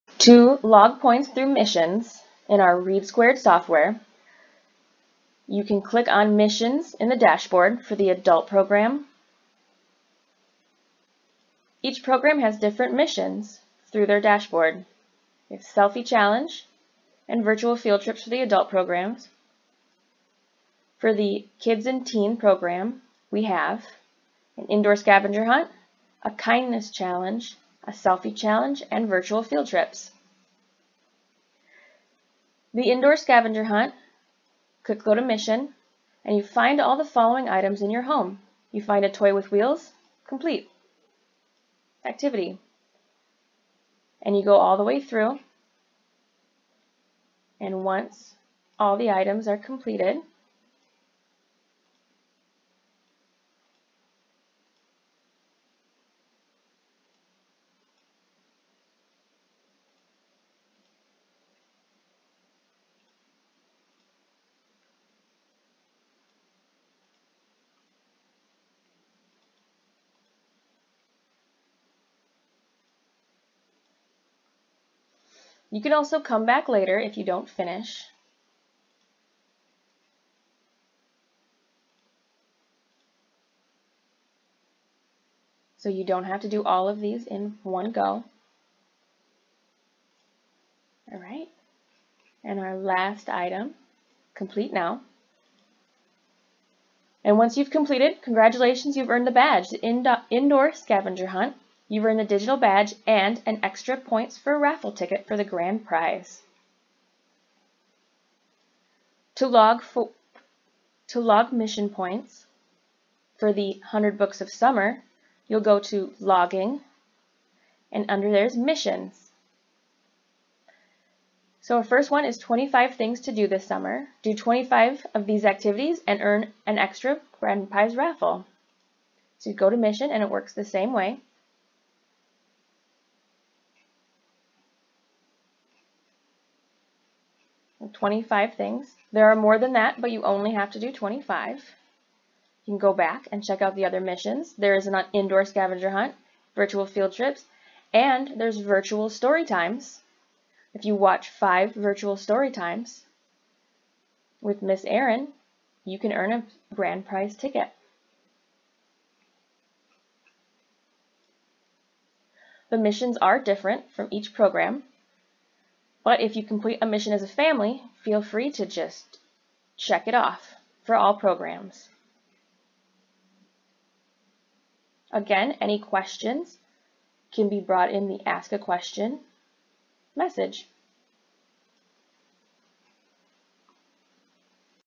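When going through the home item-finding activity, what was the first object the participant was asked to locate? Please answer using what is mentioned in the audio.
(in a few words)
A toy with wheels.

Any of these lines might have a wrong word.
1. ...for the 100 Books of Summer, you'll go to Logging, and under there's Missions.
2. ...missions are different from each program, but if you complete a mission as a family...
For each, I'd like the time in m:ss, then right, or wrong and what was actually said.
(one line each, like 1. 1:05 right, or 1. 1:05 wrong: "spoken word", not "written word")
1. 1:53 right
2. 2:42 right.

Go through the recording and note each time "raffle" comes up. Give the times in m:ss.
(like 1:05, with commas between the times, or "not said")
1:44, 2:07.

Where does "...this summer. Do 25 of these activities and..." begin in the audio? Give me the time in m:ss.
2:03.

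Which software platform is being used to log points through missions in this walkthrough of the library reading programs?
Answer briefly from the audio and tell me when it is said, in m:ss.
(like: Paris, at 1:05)
READsquared, at 0:02.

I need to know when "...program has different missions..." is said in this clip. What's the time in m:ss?
0:12.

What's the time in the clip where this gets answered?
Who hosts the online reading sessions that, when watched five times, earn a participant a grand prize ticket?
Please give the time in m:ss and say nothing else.
2:34.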